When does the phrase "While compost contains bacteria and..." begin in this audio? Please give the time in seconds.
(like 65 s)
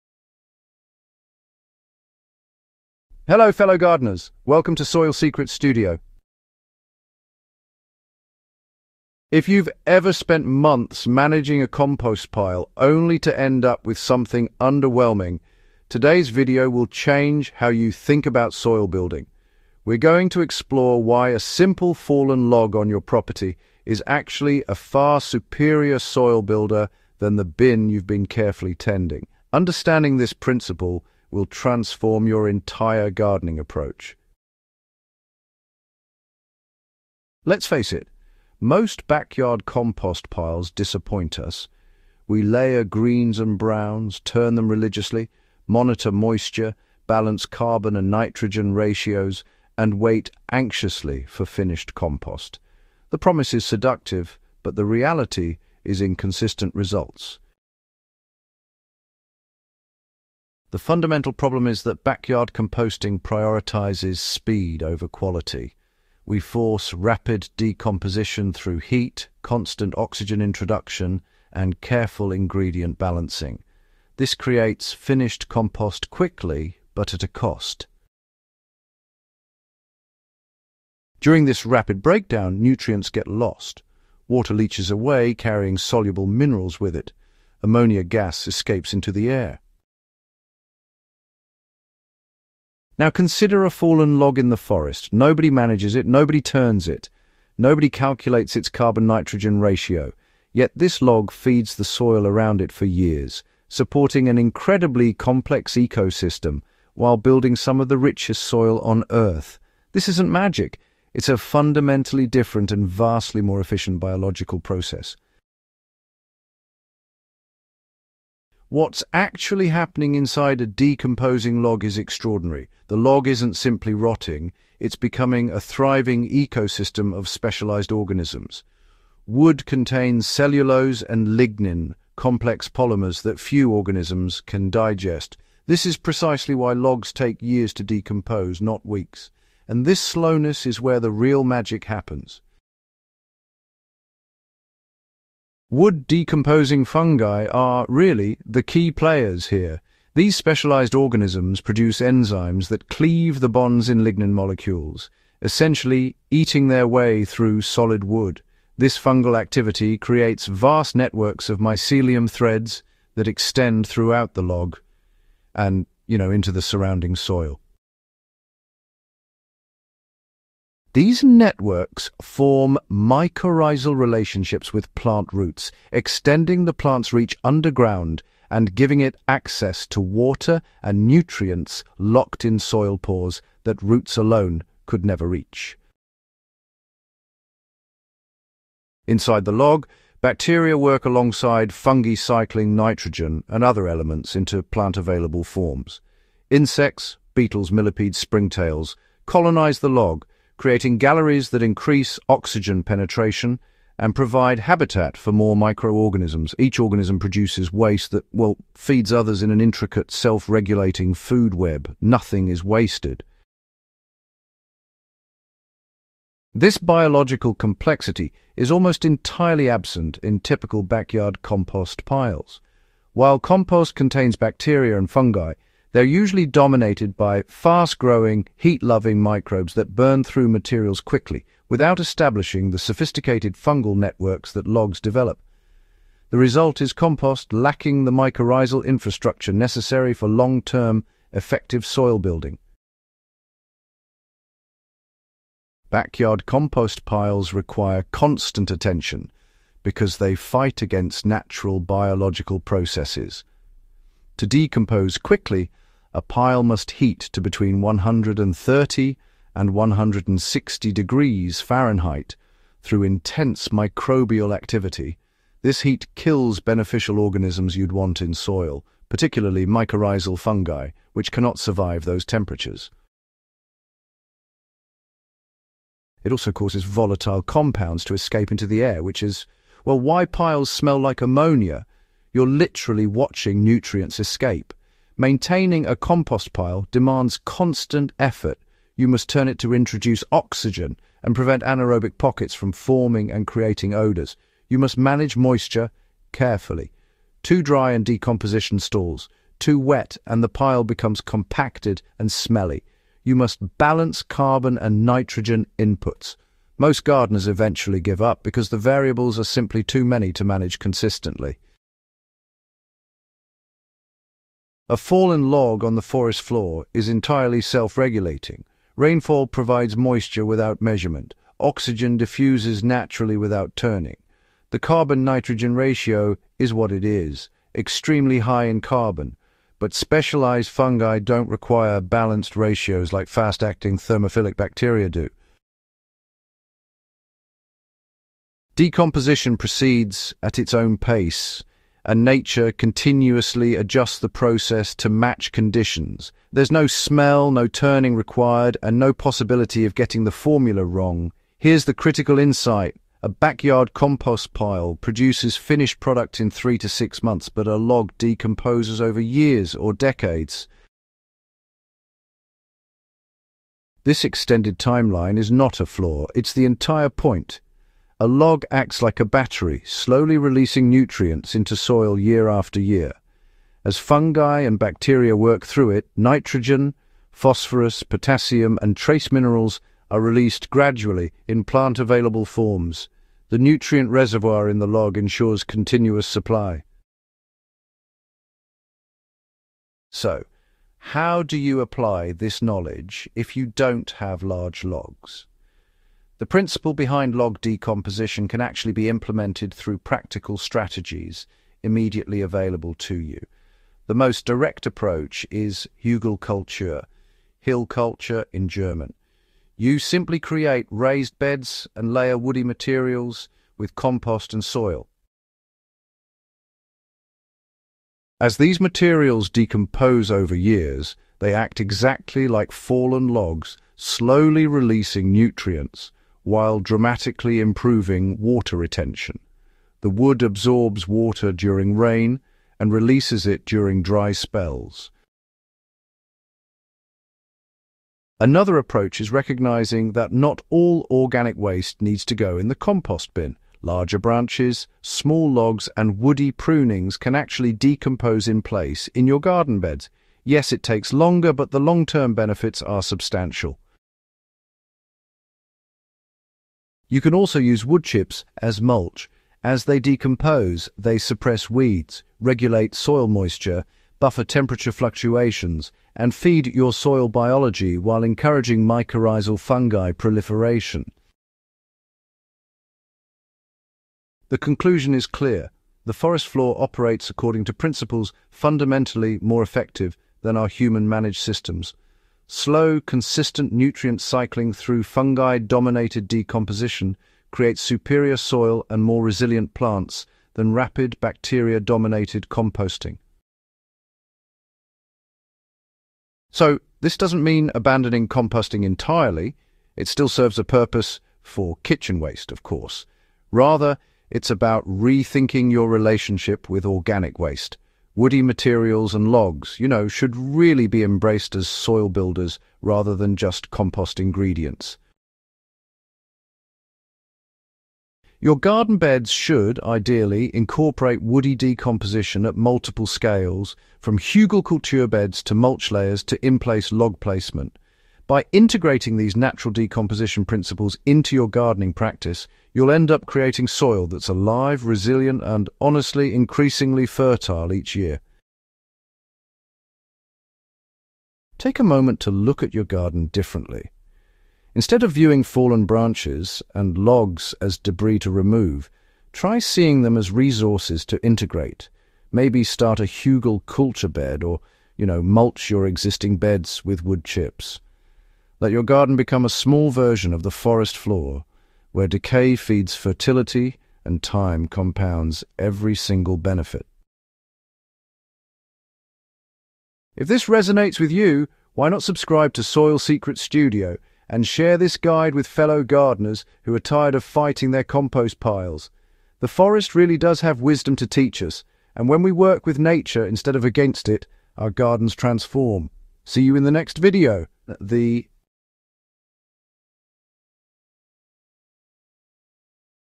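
223 s.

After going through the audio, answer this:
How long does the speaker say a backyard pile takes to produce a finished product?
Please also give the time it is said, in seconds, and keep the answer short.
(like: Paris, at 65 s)
3 to 6 months, at 356 s.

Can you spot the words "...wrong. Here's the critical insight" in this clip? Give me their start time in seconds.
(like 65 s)
350 s.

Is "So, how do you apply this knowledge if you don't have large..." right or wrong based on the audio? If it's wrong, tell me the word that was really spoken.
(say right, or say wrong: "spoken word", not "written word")
right.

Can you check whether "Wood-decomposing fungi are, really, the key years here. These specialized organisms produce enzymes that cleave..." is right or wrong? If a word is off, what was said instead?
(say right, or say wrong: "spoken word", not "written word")
wrong: "players", not "years".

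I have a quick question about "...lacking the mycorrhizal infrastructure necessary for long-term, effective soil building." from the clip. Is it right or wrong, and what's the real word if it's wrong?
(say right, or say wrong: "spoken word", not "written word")
right.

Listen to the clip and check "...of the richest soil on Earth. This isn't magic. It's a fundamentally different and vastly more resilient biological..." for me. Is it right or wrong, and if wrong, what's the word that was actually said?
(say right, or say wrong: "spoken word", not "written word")
wrong: "efficient", not "resilient".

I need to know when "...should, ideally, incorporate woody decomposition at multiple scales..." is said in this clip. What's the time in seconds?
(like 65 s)
519 s.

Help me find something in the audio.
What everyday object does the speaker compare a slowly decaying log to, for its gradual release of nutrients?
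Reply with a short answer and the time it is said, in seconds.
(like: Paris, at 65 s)
A battery, at 369 s.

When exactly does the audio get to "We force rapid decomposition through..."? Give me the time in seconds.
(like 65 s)
66 s.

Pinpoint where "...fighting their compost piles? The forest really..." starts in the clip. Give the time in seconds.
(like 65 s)
577 s.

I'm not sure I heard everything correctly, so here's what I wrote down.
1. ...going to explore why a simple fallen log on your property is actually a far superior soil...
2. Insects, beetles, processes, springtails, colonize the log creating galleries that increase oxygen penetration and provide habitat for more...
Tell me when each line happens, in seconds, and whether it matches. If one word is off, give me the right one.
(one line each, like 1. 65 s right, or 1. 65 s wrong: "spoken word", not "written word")
1. 19 s right
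2. 196 s wrong: "millipedes", not "processes".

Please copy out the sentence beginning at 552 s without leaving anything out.
Maybe start a Hügelkultur bed or, you know, mulch your existing beds with wood chips.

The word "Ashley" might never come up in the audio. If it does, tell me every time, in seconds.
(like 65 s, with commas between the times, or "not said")
not said.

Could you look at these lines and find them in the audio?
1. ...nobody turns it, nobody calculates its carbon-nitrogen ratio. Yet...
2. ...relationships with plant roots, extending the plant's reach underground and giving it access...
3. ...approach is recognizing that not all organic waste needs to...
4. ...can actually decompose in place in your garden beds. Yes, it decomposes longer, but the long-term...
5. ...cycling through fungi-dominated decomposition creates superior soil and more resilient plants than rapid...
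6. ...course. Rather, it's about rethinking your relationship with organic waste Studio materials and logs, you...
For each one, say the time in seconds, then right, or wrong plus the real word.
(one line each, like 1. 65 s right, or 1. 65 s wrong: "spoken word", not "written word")
1. 96 s right
2. 173 s right
3. 438 s right
4. 447 s wrong: "takes", not "decomposes"
5. 484 s right
6. 502 s wrong: "Woody", not "Studio".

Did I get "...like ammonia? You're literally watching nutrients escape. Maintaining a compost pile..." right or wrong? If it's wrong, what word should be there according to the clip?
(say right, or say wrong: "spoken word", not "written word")
right.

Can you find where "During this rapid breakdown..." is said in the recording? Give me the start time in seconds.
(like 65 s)
81 s.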